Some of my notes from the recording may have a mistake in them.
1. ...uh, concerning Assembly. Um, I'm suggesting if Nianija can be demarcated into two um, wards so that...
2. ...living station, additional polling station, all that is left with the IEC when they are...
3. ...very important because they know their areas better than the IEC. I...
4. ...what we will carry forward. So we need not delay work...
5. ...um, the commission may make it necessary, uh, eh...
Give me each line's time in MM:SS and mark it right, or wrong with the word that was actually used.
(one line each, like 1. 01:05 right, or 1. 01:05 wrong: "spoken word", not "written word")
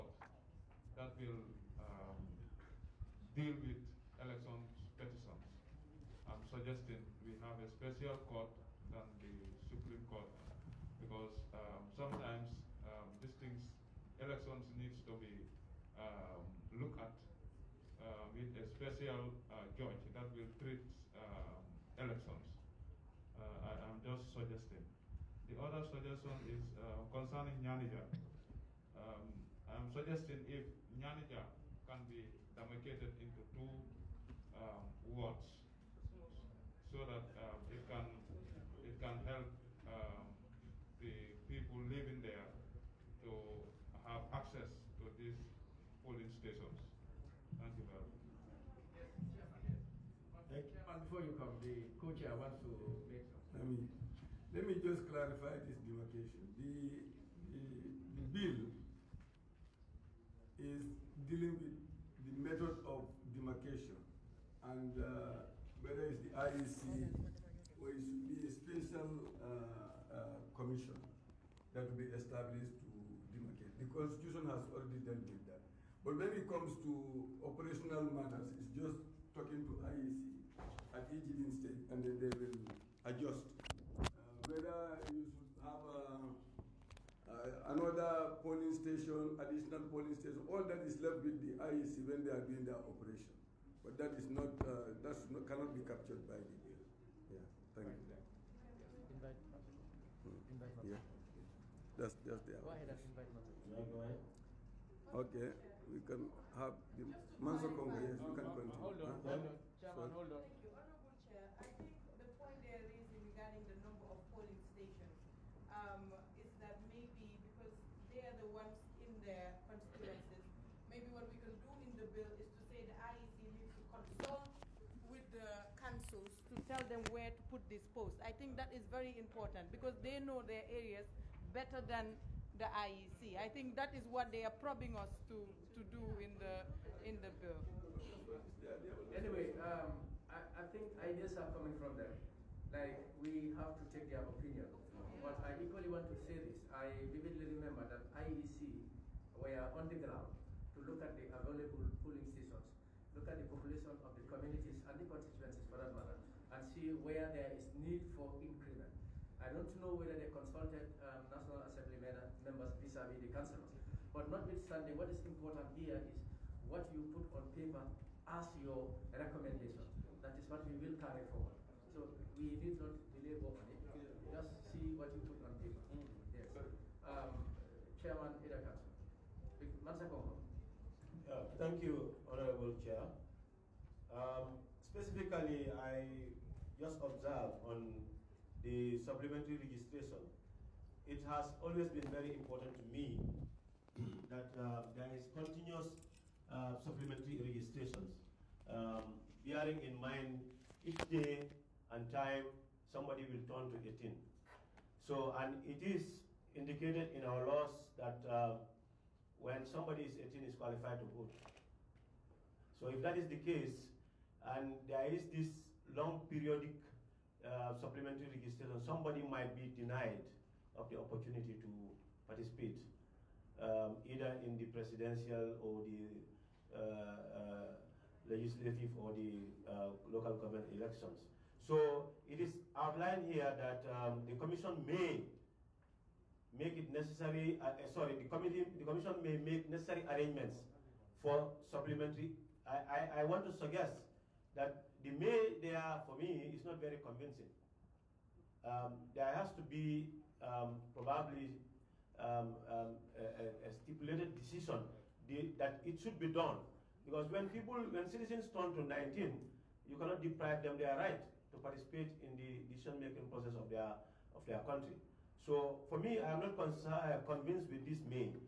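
1. 00:26 wrong: "Nianija", not "Assembly"
2. 01:28 wrong: "polling", not "living"
3. 02:08 right
4. 02:50 right
5. 03:53 right.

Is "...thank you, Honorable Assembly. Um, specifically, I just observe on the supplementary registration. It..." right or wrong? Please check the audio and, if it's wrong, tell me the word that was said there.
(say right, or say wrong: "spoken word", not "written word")
wrong: "Chair", not "Assembly".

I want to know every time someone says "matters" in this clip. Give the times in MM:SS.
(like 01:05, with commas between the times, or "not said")
01:18, 02:35.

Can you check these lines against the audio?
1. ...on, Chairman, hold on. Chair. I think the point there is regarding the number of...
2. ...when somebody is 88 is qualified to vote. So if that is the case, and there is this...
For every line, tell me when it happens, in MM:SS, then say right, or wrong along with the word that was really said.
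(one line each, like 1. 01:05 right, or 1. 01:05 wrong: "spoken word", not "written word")
1. 01:49 right
2. 03:29 wrong: "18", not "88".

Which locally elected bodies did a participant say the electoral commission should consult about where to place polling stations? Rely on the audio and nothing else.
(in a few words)
the councils.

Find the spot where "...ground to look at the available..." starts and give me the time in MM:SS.
02:29.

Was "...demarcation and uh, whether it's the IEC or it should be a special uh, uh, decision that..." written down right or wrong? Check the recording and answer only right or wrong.
wrong.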